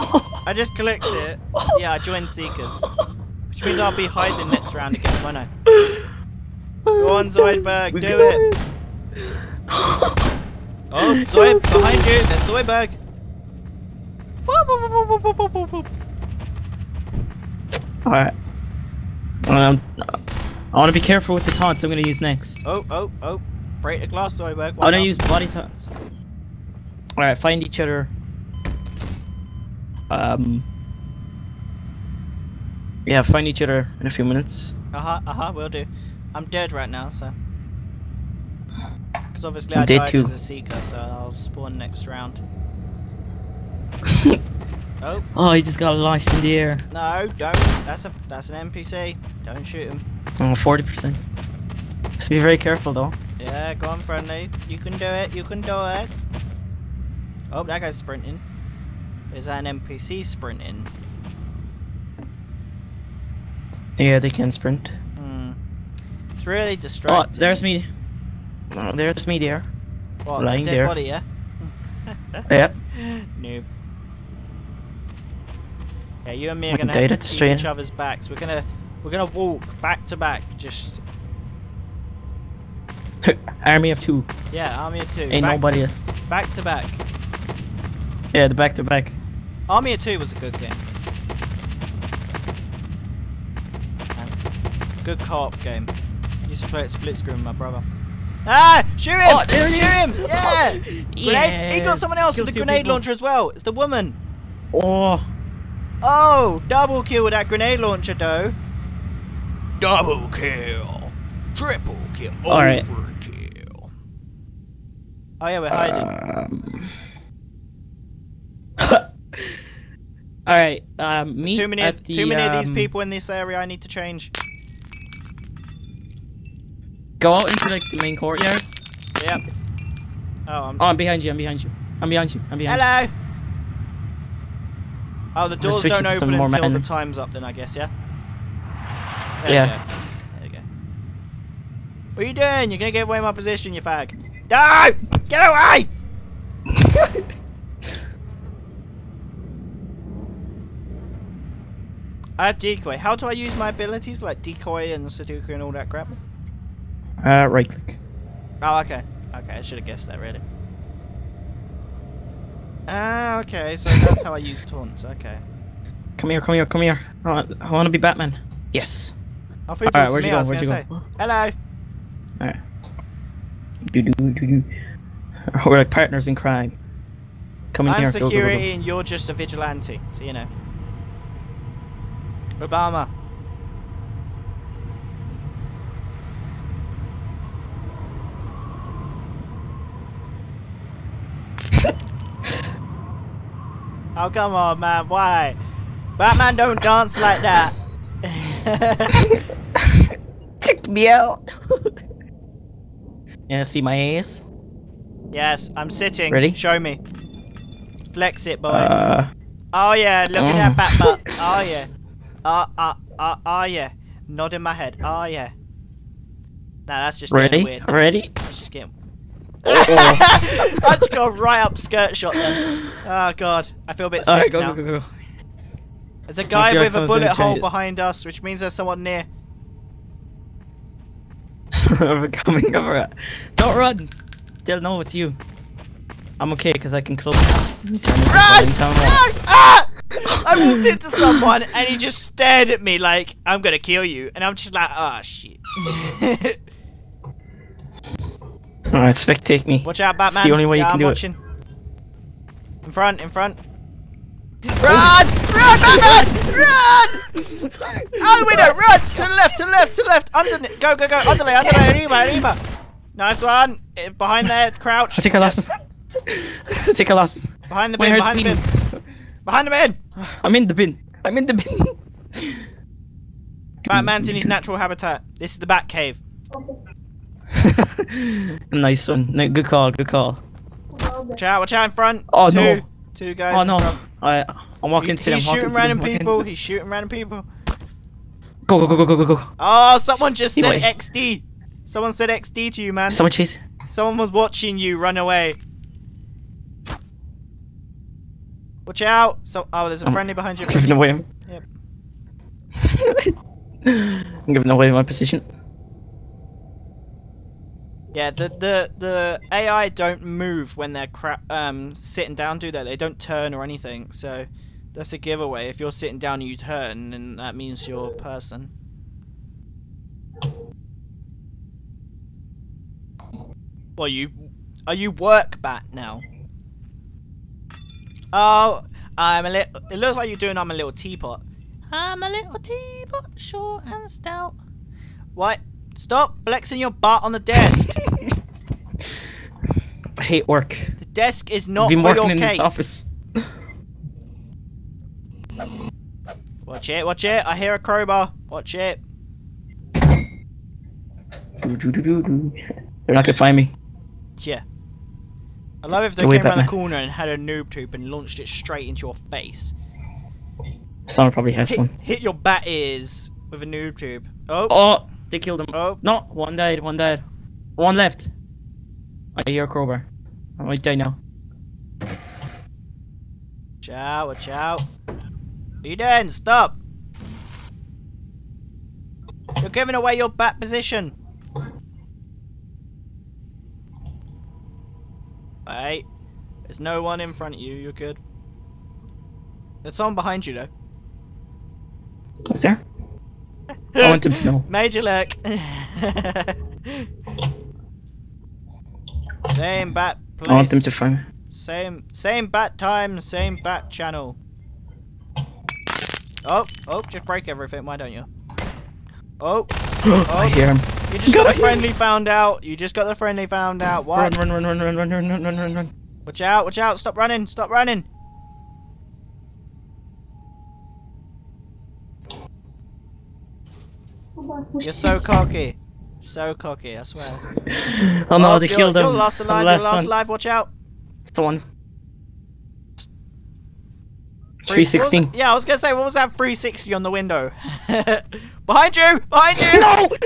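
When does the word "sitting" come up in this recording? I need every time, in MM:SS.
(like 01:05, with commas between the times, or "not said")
03:25, 05:11, 05:15.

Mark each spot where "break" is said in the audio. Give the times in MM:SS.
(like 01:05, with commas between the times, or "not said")
00:23, 06:47.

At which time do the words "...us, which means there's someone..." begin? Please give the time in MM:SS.
03:48.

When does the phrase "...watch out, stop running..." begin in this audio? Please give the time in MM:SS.
06:56.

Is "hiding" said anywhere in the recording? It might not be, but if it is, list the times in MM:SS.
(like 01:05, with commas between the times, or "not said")
00:04, 01:55.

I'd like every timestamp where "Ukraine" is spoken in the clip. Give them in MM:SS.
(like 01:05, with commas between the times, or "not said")
not said.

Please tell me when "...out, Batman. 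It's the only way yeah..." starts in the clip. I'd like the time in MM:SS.
04:10.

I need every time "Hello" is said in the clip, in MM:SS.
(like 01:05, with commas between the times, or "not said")
02:12, 02:51.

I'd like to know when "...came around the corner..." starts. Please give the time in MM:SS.
05:56.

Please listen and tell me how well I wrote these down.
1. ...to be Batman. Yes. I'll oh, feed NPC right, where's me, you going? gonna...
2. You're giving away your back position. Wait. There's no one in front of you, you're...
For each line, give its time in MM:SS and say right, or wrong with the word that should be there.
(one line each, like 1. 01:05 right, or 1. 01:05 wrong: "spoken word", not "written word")
1. 02:47 wrong: "All", not "NPC"
2. 06:19 right.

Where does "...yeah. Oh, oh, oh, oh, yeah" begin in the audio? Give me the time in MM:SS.
03:31.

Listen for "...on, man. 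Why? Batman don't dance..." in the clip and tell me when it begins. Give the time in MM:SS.
03:14.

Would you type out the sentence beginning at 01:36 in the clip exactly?
I used to play it split screen with my brother.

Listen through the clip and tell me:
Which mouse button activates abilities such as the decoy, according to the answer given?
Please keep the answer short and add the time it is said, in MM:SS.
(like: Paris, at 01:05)
right click, at 02:37.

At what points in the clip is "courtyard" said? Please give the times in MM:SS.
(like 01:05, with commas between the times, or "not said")
02:08.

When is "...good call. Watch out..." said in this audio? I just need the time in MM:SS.
04:39.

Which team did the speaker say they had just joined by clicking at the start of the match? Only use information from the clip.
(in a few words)
Seekers.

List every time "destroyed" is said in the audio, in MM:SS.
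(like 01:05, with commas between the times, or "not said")
not said.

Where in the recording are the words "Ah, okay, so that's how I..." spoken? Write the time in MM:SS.
02:42.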